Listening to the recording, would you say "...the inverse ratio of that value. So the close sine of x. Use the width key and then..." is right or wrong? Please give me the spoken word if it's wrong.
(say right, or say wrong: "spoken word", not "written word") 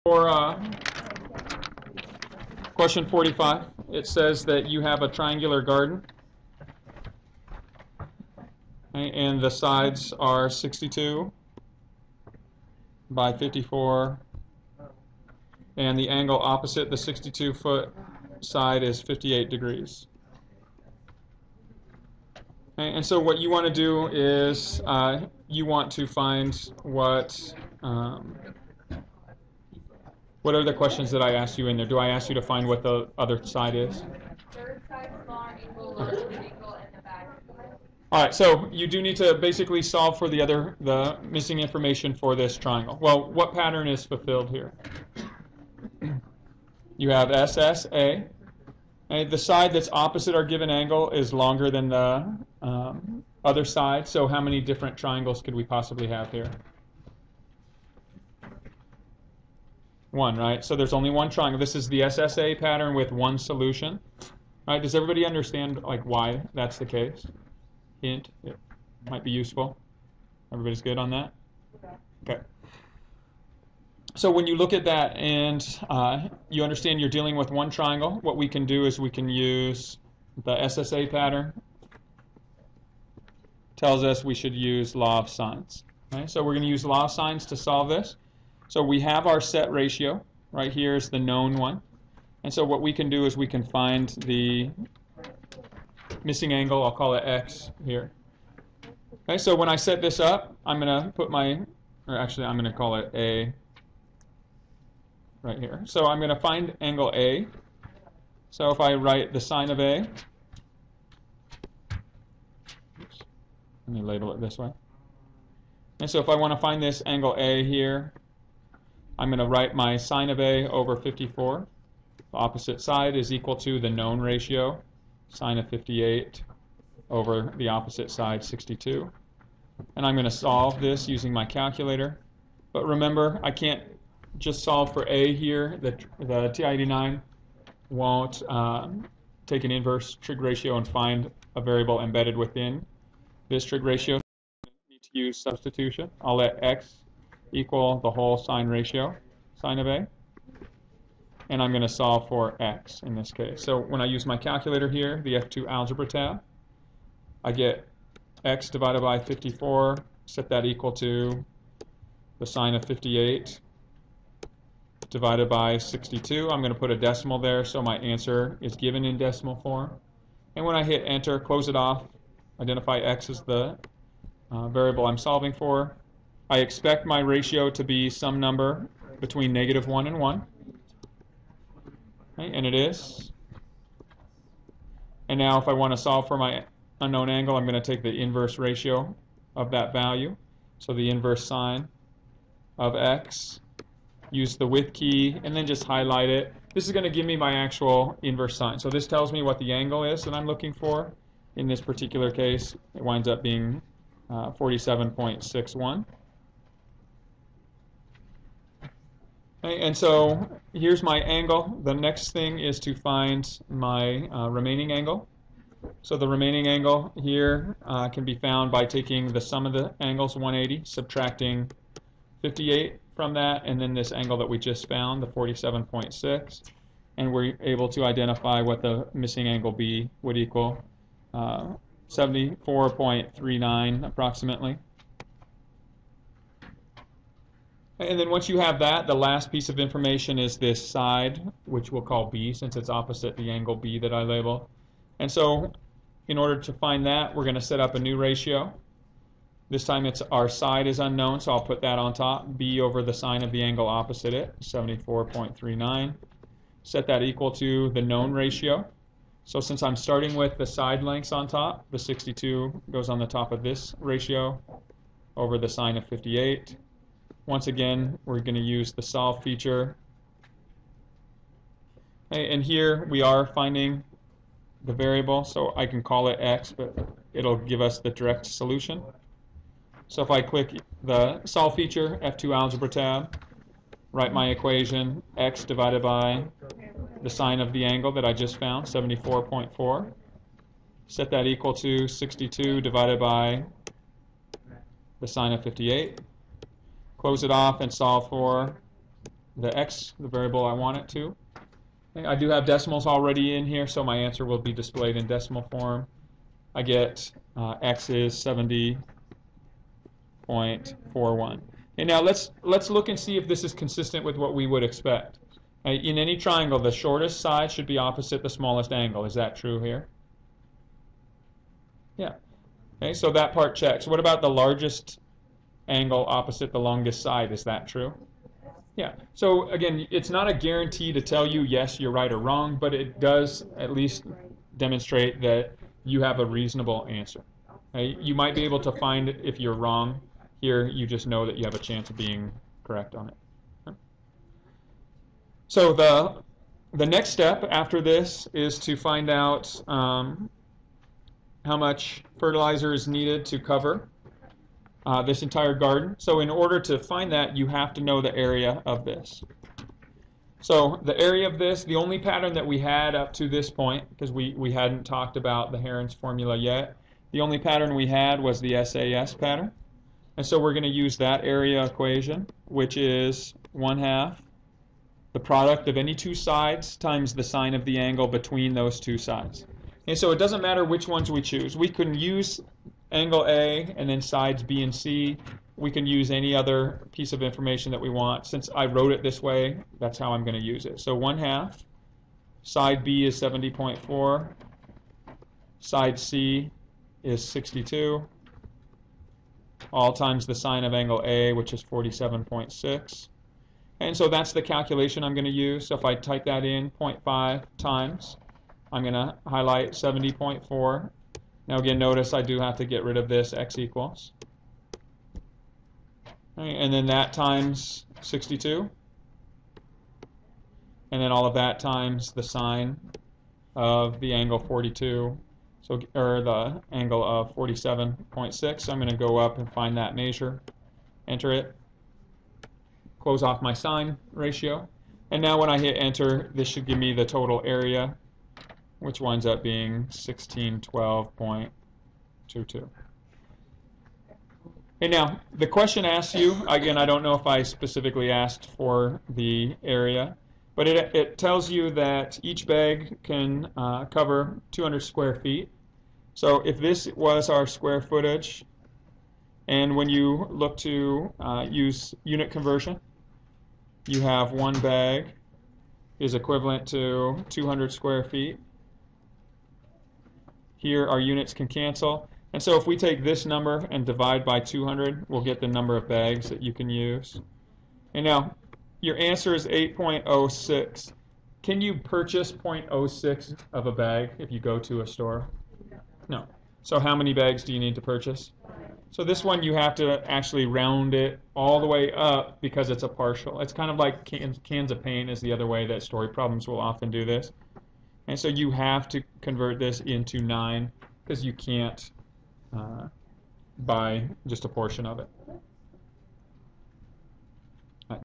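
wrong: "inverse", not "close".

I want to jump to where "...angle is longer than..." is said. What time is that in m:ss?
0:50.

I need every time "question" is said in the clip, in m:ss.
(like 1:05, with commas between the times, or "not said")
0:02, 0:30, 7:25.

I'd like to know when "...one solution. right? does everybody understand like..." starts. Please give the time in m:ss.
1:03.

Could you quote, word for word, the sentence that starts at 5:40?
Here, you just know that you have a chance of being correct on it.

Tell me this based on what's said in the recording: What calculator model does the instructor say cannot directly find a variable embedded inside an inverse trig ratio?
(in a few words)
TI-89.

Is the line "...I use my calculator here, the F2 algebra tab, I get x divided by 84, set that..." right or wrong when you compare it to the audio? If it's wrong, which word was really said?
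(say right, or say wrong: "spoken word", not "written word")
wrong: "54", not "84".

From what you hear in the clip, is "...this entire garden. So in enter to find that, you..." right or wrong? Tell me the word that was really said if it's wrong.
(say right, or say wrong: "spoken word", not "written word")
wrong: "order", not "enter".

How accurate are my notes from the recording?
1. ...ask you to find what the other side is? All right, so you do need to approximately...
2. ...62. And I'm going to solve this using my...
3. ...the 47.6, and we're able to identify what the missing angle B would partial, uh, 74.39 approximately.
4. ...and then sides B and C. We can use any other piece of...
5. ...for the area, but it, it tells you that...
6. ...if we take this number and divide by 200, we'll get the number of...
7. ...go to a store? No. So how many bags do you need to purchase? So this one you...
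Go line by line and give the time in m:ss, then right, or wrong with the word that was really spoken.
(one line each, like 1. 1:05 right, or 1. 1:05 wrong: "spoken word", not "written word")
1. 0:32 wrong: "basically", not "approximately"
2. 2:08 right
3. 3:45 wrong: "equal", not "partial"
4. 6:23 right
5. 7:28 right
6. 7:52 right
7. 8:04 right.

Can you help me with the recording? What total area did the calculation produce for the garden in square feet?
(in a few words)
1612.22.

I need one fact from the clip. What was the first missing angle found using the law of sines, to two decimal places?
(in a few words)
47.61.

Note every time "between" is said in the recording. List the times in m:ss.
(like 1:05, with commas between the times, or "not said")
2:59, 6:18.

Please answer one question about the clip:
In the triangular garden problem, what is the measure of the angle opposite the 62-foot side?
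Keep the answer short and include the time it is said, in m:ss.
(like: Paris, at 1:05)
58 degrees, at 0:19.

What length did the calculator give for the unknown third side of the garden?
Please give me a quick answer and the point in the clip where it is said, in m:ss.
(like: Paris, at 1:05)
70.41, at 5:08.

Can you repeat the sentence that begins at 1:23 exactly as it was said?
Tells us we should use law of sines.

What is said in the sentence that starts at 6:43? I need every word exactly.
And so that's the calculation I'm going to use.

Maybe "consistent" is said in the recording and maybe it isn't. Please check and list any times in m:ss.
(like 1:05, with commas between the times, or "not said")
5:13.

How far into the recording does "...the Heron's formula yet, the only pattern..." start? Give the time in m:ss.
6:05.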